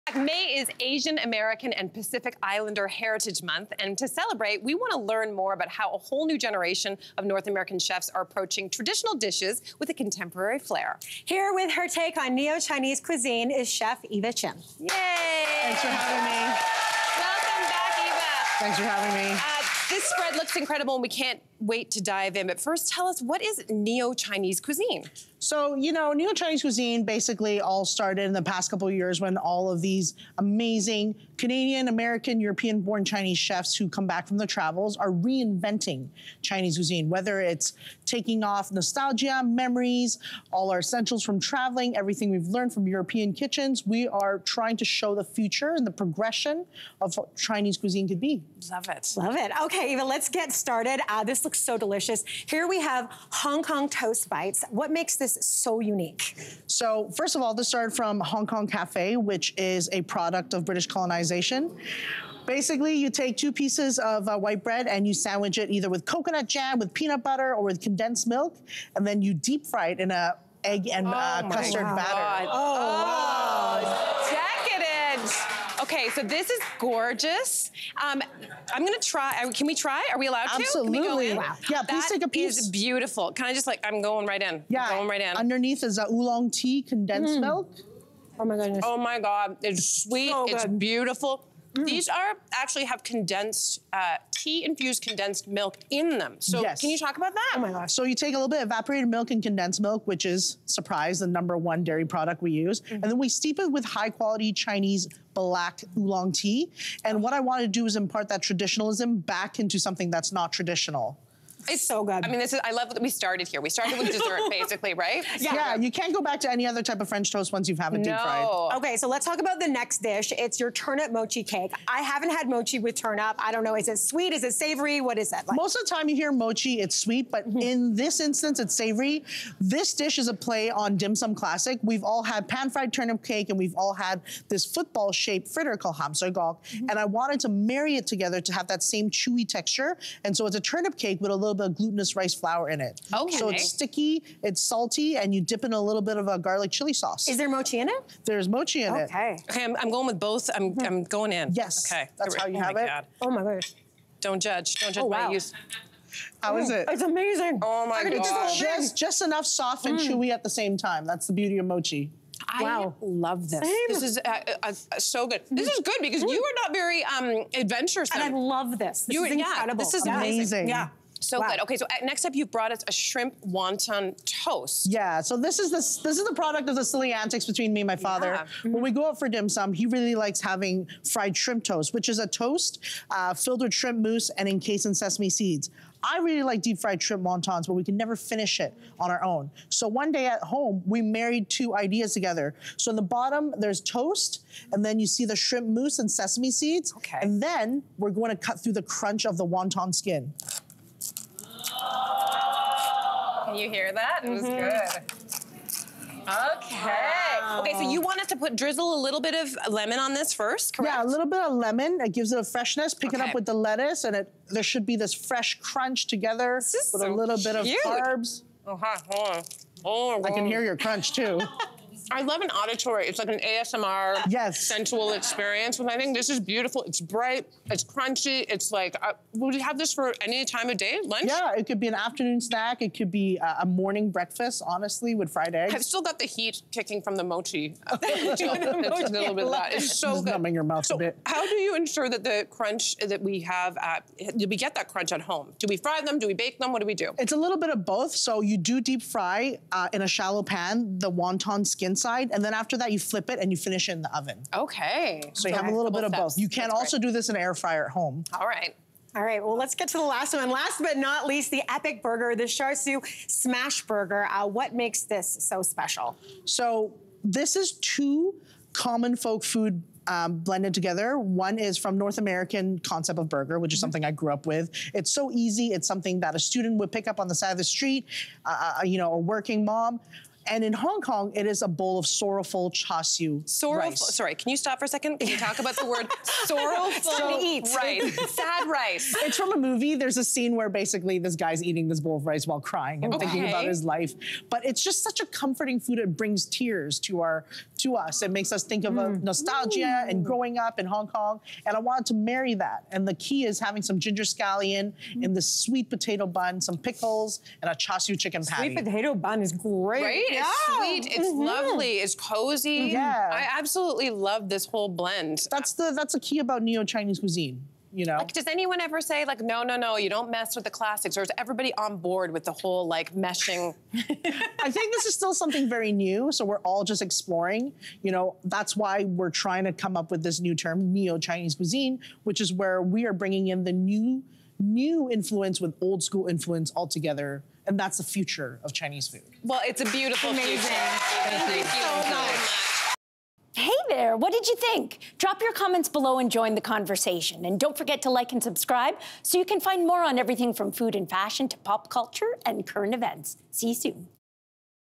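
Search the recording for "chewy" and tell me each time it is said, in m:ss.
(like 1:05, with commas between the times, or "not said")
2:19, 2:40.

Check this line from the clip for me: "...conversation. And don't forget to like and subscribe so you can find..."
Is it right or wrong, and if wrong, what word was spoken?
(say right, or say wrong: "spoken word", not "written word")
right.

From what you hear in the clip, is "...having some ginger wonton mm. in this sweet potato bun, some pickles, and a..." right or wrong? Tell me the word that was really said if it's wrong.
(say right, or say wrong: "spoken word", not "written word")
wrong: "scallion", not "wonton".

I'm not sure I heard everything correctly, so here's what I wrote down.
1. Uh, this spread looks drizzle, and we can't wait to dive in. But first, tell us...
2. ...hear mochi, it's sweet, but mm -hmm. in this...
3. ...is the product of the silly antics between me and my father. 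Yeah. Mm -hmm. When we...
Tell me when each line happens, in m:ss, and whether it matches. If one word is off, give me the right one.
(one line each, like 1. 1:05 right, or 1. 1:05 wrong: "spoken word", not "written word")
1. 0:19 wrong: "incredible", not "drizzle"
2. 2:06 right
3. 2:56 right.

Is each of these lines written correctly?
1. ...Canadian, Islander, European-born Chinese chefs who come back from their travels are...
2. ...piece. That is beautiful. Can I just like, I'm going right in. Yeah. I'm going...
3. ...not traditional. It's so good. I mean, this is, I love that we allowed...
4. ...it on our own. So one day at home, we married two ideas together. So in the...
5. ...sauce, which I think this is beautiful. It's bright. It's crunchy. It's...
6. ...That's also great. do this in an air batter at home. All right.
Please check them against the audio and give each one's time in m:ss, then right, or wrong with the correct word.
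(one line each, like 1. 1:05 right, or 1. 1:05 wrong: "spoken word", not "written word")
1. 0:31 wrong: "American", not "Islander"
2. 1:22 right
3. 1:50 wrong: "started", not "allowed"
4. 3:08 right
5. 3:45 wrong: "experience", not "sauce"
6. 4:16 wrong: "fryer", not "batter".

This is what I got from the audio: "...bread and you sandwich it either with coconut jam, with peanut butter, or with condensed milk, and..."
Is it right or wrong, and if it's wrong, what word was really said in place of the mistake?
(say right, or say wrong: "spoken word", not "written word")
right.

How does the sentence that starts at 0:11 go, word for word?
Here with her take on neo-Chinese cuisine is Chef Eva Chin.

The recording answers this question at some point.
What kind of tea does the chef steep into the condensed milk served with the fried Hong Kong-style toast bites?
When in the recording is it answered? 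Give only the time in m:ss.
1:44.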